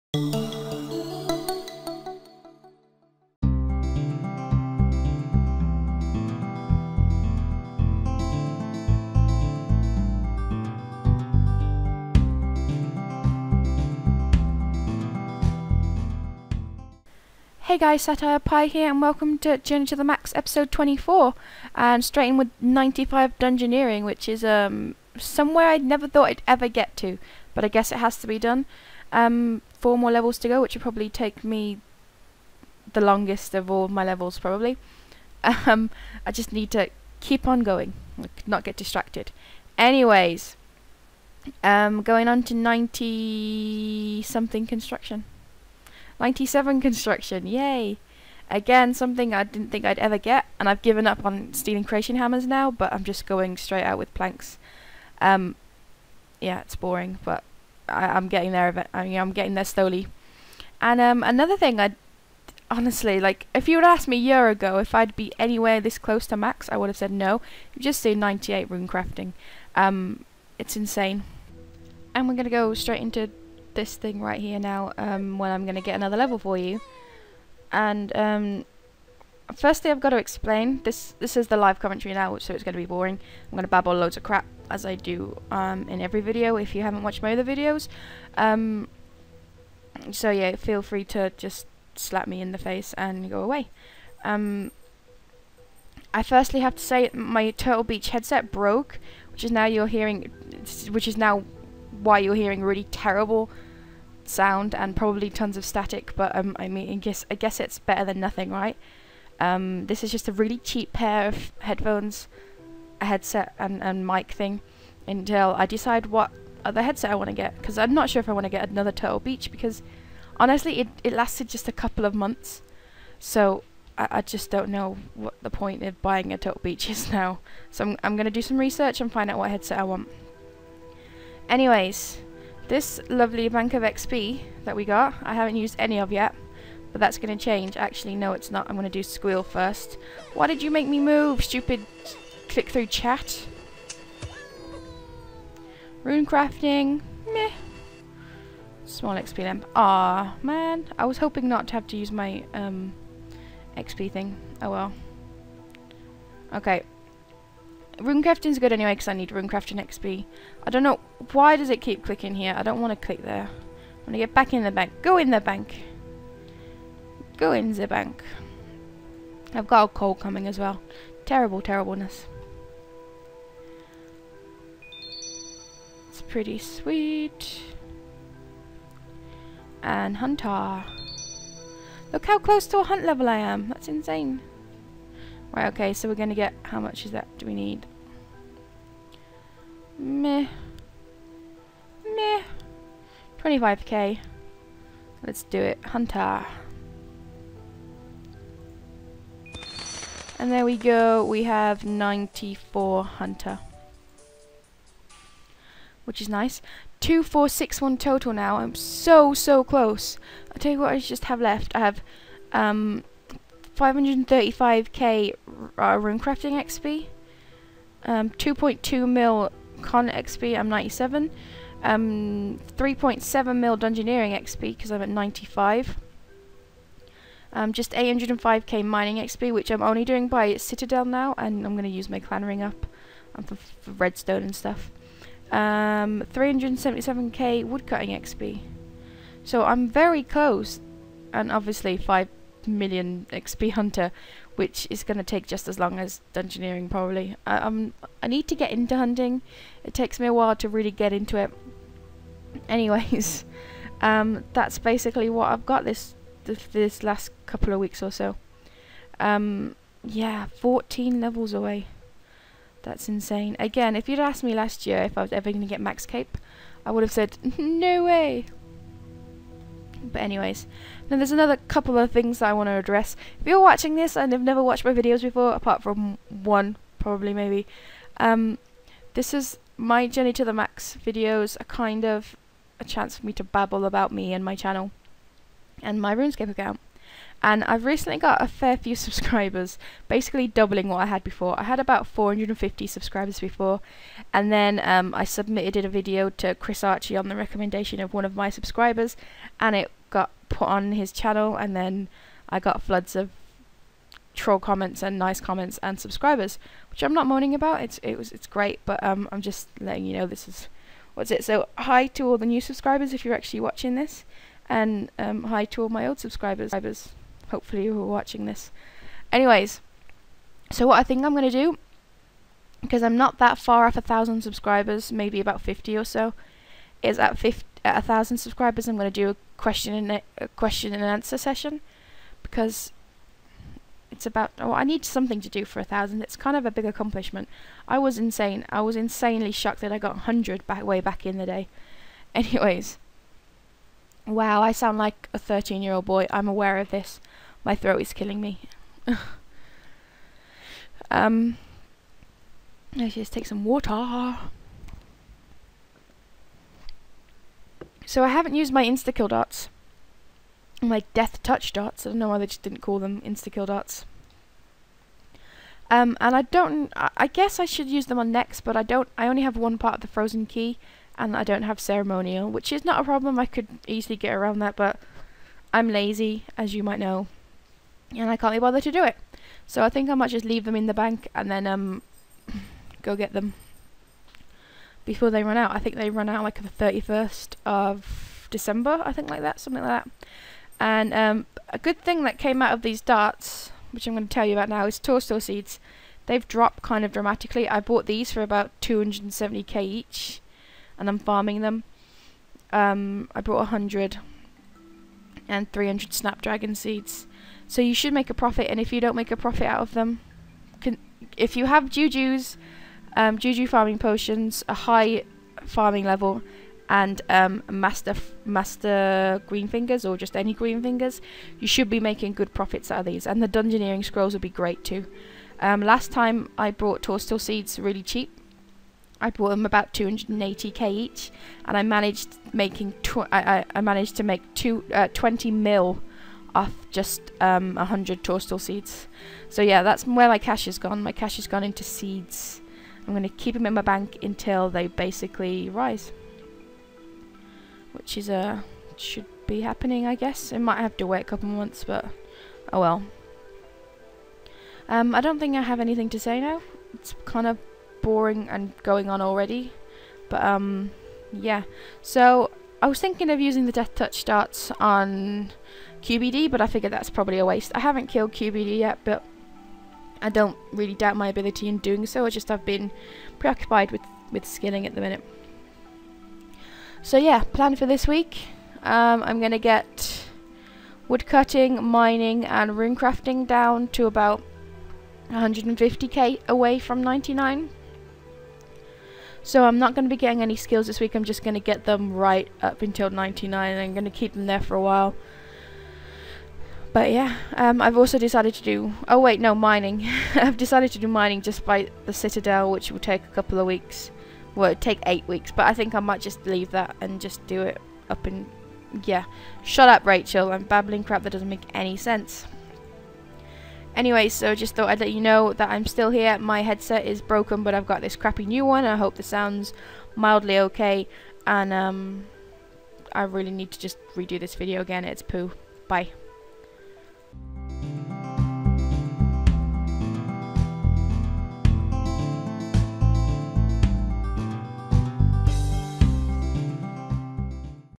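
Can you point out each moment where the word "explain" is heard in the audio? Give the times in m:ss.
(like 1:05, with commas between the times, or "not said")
1:20.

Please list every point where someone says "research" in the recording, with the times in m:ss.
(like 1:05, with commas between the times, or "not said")
2:08.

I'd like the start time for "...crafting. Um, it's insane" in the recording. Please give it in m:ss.
1:08.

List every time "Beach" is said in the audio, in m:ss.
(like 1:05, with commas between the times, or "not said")
1:37, 1:59, 2:06.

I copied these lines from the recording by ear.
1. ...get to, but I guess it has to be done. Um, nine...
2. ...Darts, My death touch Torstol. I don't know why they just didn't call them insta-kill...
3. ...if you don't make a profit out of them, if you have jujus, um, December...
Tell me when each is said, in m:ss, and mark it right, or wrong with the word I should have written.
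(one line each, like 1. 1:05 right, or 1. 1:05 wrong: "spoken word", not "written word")
1. 0:26 wrong: "four", not "nine"
2. 5:59 wrong: "Darts", not "Torstol"
3. 6:48 wrong: "Juju", not "December".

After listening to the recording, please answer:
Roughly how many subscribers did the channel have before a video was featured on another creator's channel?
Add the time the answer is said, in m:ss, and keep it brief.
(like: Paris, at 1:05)
450, at 4:52.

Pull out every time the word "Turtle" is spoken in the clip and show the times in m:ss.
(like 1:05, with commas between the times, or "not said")
1:37, 1:58, 2:06.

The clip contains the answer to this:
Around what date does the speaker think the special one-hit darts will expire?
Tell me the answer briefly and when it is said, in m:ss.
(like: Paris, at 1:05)
31st of December, at 6:26.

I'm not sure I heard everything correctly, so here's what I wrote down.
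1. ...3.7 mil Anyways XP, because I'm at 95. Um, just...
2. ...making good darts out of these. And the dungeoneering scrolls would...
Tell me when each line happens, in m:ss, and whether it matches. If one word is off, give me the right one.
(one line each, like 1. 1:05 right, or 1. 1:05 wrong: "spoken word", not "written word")
1. 3:42 wrong: "Dungeoneering", not "Anyways"
2. 7:01 wrong: "profits", not "darts".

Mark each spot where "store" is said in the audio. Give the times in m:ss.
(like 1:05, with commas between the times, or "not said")
not said.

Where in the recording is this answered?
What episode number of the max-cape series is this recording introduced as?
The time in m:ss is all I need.
0:20.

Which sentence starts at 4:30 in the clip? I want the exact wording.
But anyways, now there's another couple of things that I want to address.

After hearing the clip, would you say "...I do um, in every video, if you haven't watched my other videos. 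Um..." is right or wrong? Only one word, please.
right.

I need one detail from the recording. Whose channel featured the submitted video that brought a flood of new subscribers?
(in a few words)
Chris Archie.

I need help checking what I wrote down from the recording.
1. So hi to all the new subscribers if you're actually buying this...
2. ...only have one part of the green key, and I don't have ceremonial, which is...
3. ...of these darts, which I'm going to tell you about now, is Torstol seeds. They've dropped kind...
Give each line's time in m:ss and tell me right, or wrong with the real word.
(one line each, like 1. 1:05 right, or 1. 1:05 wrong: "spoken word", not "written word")
1. 5:11 wrong: "watching", not "buying"
2. 6:09 wrong: "frozen", not "green"
3. 6:32 right.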